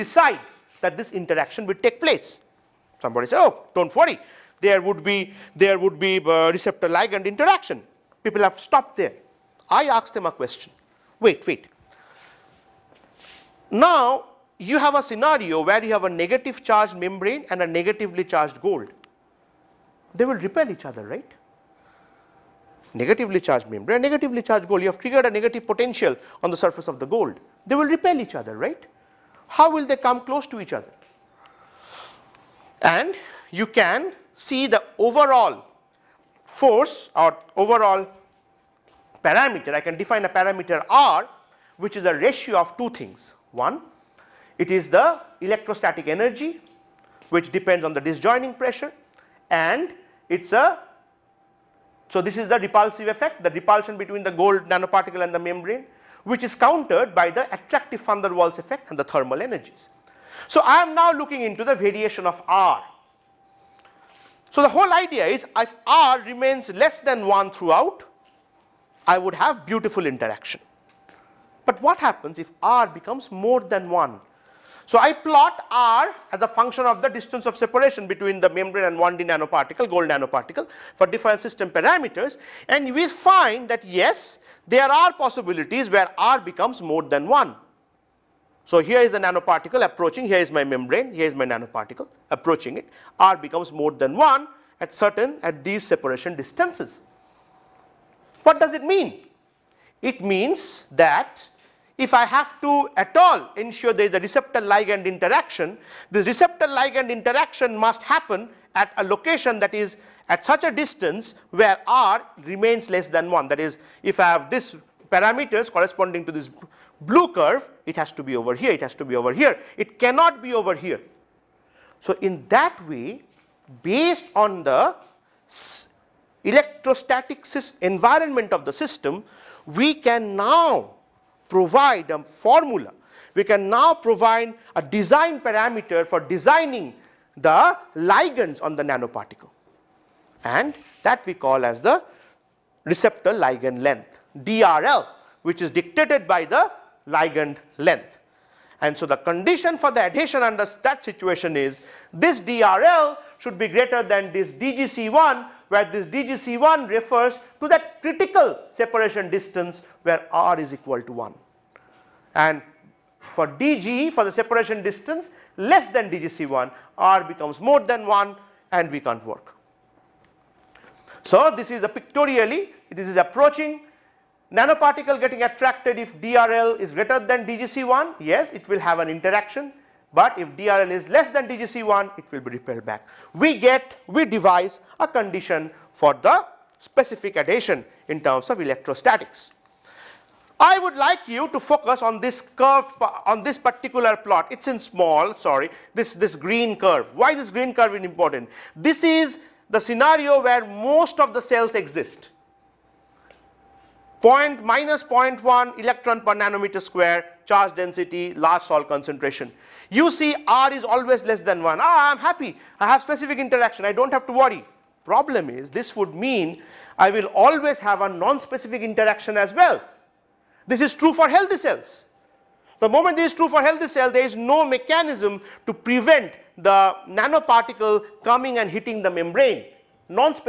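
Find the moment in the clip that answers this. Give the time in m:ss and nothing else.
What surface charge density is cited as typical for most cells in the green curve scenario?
3:24.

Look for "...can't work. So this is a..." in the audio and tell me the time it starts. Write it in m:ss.
2:48.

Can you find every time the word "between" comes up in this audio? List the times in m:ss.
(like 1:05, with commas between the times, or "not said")
0:53, 1:18.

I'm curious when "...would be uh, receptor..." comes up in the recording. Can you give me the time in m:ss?
0:05.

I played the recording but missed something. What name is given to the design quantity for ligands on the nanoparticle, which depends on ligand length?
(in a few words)
receptor ligand length.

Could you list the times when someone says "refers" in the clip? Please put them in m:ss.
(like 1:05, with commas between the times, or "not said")
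2:36.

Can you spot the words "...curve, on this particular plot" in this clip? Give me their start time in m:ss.
3:12.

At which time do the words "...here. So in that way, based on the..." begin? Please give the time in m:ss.
2:00.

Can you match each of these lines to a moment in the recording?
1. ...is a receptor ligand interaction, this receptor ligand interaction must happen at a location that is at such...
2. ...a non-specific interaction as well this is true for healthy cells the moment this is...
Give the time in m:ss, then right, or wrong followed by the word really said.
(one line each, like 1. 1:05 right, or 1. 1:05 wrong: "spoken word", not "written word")
1. 1:44 right
2. 3:38 right.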